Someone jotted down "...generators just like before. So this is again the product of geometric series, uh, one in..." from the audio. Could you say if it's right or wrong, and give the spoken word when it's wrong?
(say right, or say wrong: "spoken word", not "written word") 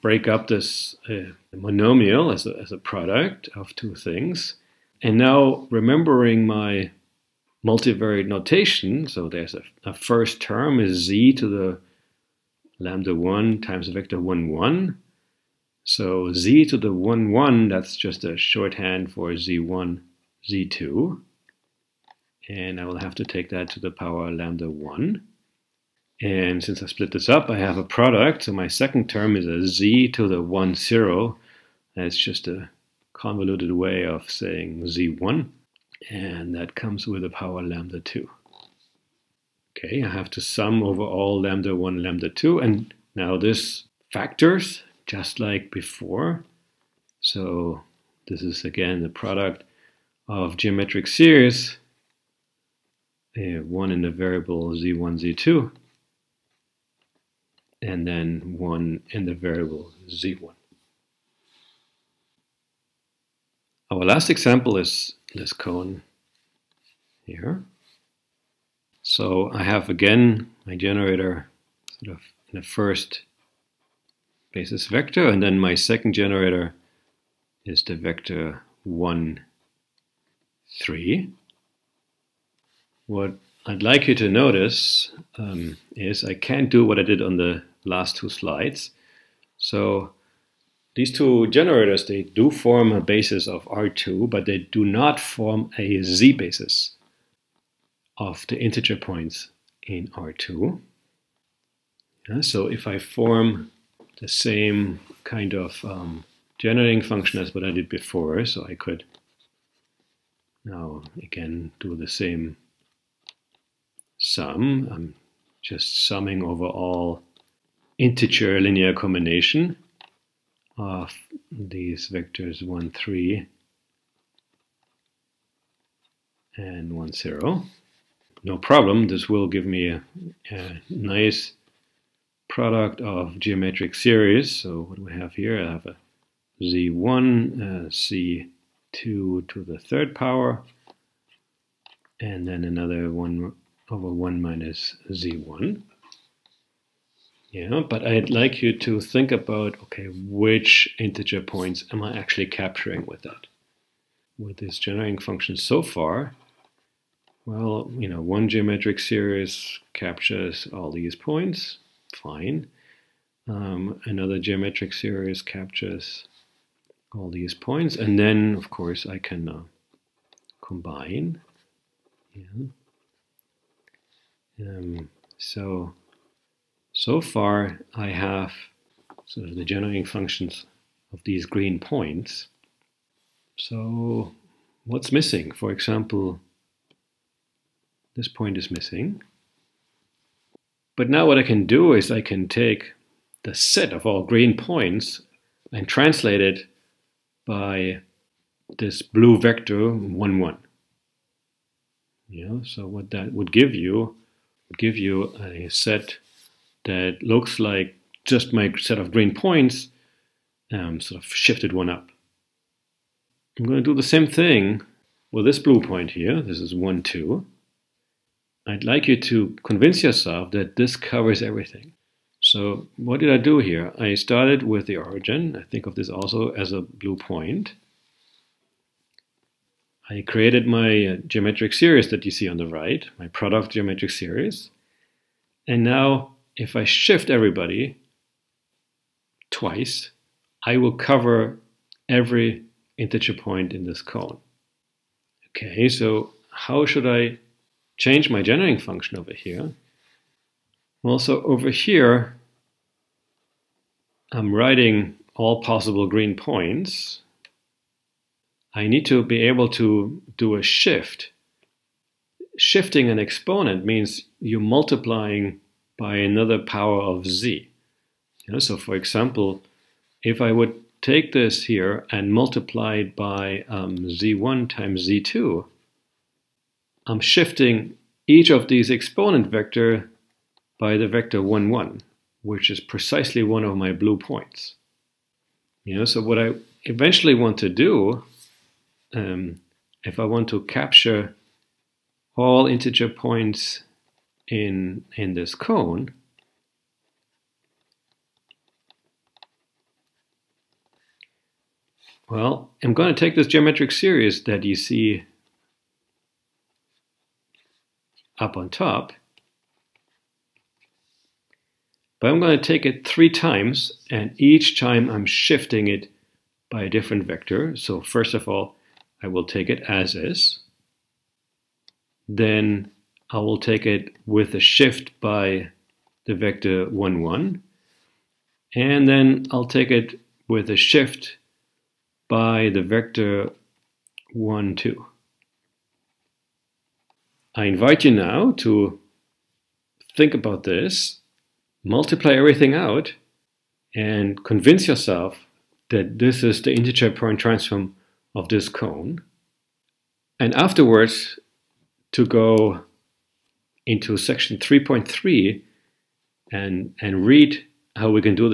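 wrong: "factors", not "generators".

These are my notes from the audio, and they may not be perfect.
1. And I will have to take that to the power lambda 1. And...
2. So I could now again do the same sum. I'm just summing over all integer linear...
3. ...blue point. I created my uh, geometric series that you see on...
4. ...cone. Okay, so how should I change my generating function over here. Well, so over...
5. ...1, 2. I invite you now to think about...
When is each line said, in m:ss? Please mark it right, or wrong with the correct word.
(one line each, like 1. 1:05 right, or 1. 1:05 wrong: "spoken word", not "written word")
1. 0:22 right
2. 1:48 right
3. 3:46 right
4. 4:04 right
5. 5:34 right.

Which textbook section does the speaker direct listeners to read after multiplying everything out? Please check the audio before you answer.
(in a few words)
Section 3.3.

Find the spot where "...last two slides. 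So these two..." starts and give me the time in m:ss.
1:27.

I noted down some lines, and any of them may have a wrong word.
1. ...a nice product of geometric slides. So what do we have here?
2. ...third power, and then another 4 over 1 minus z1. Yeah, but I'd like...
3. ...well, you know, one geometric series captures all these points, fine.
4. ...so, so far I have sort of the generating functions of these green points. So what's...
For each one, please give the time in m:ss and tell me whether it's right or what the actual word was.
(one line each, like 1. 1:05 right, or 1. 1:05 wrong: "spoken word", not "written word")
1. 2:10 wrong: "series", not "slides"
2. 2:19 wrong: "1", not "4"
3. 2:37 right
4. 2:55 right.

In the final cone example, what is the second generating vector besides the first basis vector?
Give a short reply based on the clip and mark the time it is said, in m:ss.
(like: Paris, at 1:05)
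1, 3, at 1:17.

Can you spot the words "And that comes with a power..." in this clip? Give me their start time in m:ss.
0:36.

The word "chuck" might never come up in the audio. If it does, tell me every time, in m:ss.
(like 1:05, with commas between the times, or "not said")
not said.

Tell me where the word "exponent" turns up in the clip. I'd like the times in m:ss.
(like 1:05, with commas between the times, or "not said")
4:23, 4:38.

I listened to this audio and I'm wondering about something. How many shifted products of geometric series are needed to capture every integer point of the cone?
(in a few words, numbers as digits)
3.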